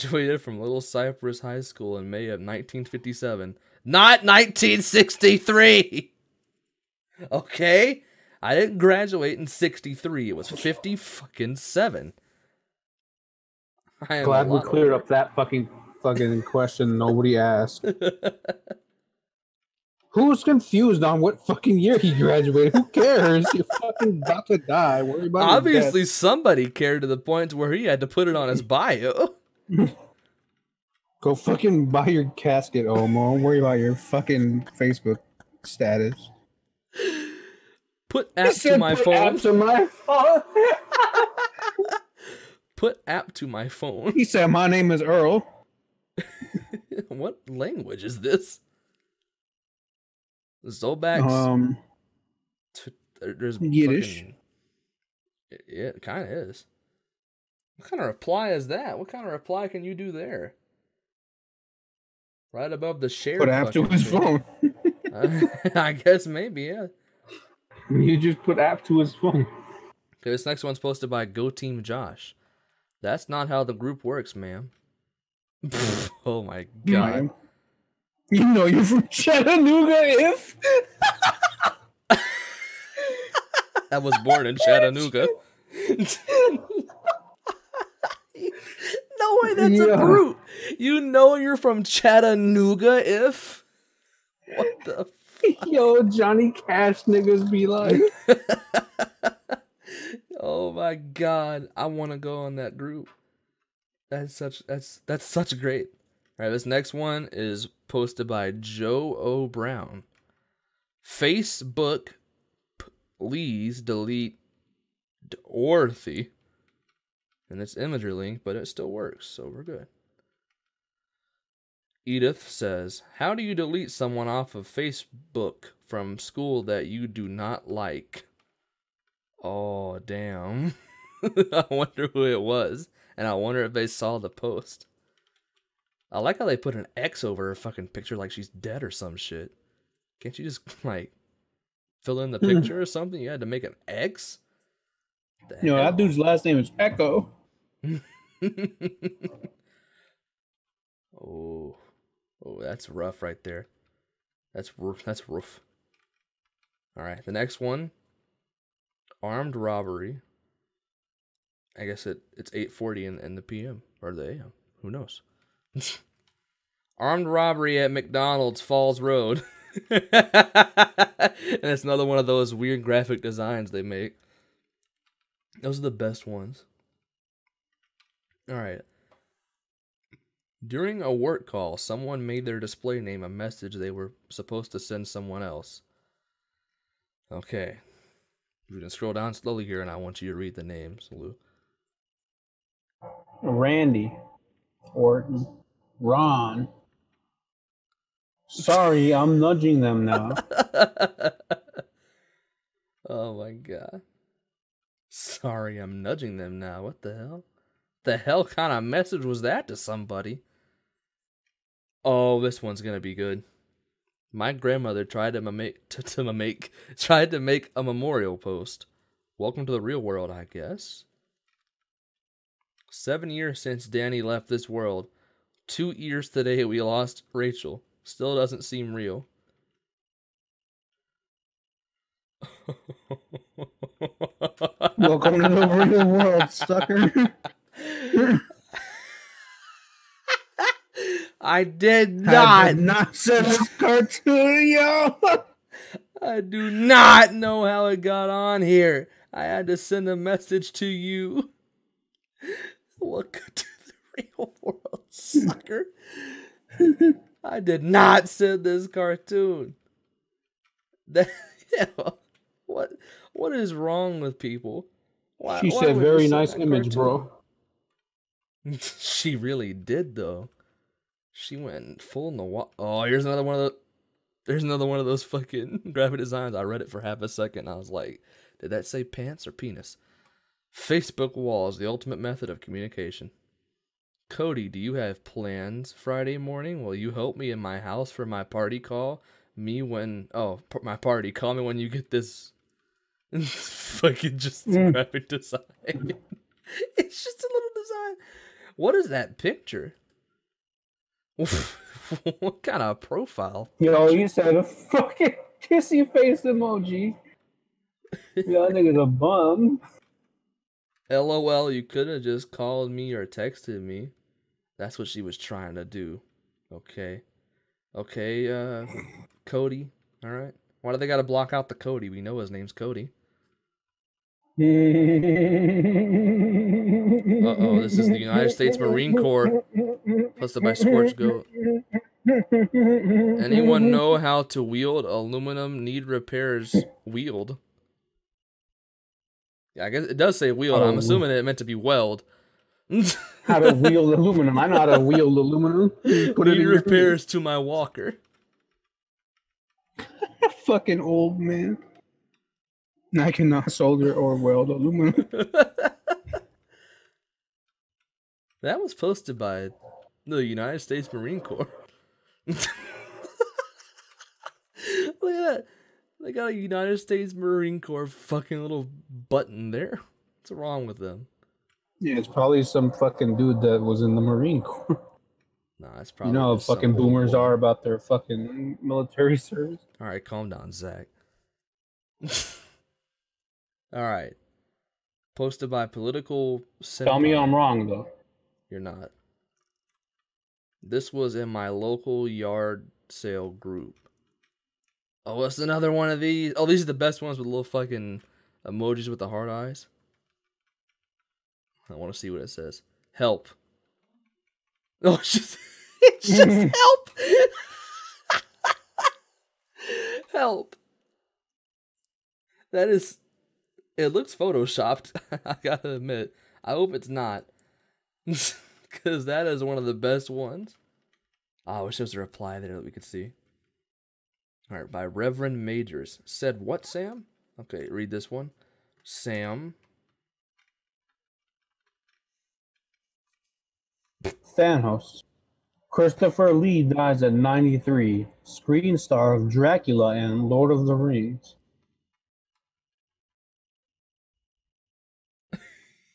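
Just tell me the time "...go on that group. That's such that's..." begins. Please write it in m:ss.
1:42.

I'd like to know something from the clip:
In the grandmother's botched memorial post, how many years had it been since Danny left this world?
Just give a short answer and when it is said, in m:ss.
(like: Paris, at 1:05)
7, at 3:42.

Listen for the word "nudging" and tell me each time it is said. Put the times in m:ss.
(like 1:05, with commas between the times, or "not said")
3:19, 3:26.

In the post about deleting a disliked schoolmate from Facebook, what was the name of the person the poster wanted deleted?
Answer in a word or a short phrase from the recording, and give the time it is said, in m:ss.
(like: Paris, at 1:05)
Dorothy, at 1:55.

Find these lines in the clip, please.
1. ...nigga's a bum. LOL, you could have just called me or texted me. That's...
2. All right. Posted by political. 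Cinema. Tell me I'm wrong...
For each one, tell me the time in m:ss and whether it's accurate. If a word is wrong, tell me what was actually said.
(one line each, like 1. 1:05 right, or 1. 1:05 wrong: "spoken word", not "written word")
1. 5:08 right
2. 6:23 right.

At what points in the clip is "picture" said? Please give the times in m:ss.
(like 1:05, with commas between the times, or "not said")
2:17, 2:22, 4:59.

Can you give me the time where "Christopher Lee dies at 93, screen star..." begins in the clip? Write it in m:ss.
7:15.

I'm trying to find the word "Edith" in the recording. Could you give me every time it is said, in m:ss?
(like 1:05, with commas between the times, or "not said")
2:02.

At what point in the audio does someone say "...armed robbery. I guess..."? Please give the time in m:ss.
2:39.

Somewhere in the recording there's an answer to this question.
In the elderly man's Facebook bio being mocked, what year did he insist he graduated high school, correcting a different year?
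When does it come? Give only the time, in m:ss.
0:02.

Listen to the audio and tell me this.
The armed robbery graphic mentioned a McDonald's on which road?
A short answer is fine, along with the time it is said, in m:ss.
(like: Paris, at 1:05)
Falls Road, at 2:48.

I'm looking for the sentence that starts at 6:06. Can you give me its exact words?
They got a United States Marine Corps fucking little button there.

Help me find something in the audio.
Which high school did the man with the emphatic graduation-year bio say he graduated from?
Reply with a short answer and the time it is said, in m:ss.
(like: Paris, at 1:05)
Little Cypress High School, at 0:00.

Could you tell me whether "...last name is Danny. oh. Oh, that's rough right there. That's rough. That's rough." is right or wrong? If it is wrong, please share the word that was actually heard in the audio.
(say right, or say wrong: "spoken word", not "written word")
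wrong: "Echo", not "Danny".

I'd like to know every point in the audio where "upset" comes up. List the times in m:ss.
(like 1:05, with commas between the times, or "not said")
not said.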